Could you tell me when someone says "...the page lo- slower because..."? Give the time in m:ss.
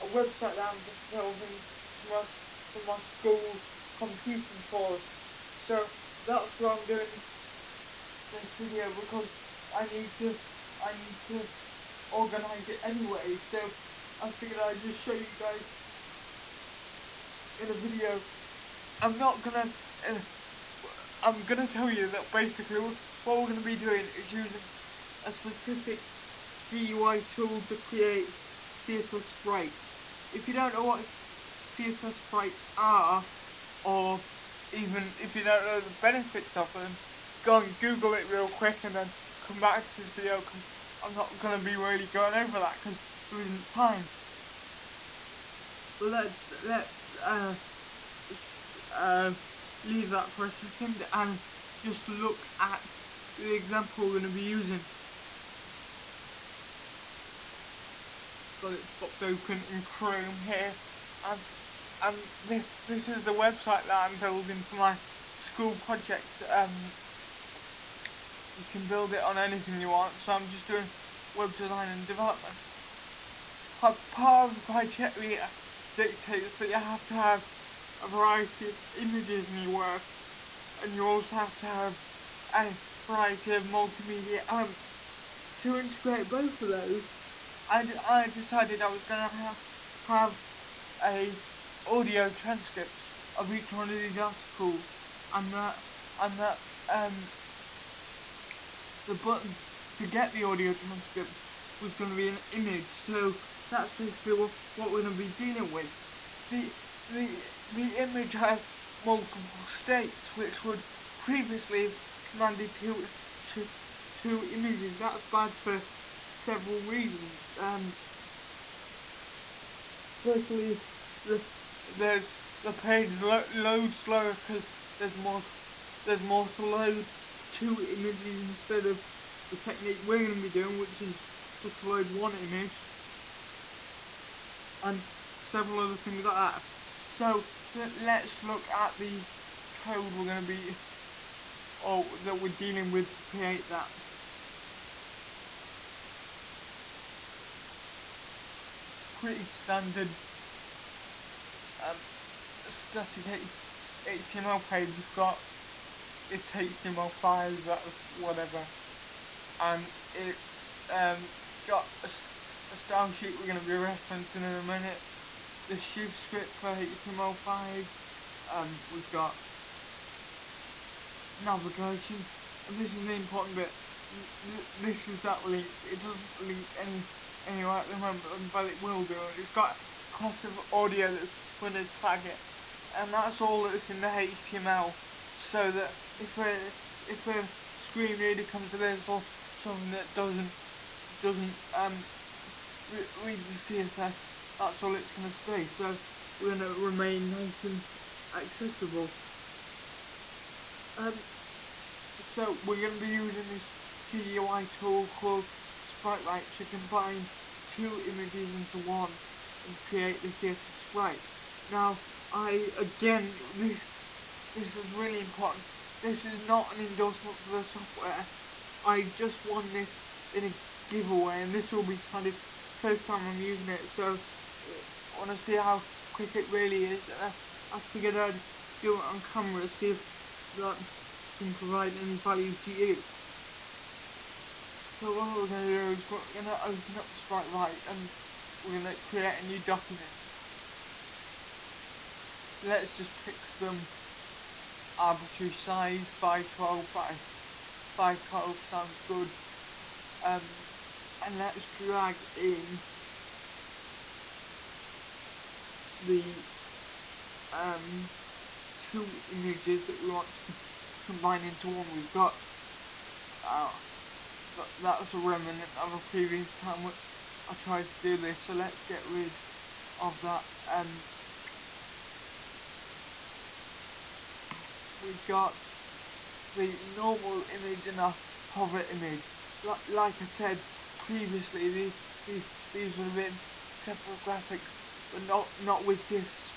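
2:02.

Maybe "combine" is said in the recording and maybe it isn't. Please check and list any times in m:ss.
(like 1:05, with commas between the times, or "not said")
3:26, 4:21.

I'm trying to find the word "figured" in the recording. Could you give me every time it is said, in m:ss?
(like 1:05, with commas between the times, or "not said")
0:14, 3:47.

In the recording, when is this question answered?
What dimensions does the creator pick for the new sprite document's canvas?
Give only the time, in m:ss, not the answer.
4:06.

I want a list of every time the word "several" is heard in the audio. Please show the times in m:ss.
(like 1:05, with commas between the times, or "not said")
1:56, 2:15.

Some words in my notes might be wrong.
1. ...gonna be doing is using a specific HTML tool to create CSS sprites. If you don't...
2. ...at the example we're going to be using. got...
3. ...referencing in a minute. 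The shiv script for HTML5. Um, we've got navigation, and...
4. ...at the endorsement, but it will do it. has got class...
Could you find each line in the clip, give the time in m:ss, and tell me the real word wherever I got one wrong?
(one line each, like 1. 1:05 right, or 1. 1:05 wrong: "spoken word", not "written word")
1. 0:23 wrong: "GUI", not "HTML"
2. 0:52 right
3. 2:43 right
4. 2:57 wrong: "moment", not "endorsement".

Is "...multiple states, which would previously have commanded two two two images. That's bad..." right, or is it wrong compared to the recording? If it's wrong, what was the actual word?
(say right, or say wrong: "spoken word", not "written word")
right.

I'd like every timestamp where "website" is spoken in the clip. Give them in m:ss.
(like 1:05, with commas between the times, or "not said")
0:00, 1:03.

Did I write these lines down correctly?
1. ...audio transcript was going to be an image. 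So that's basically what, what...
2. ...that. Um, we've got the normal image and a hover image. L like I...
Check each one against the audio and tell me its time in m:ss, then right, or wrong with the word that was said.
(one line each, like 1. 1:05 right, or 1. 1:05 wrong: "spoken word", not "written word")
1. 1:40 right
2. 4:30 right.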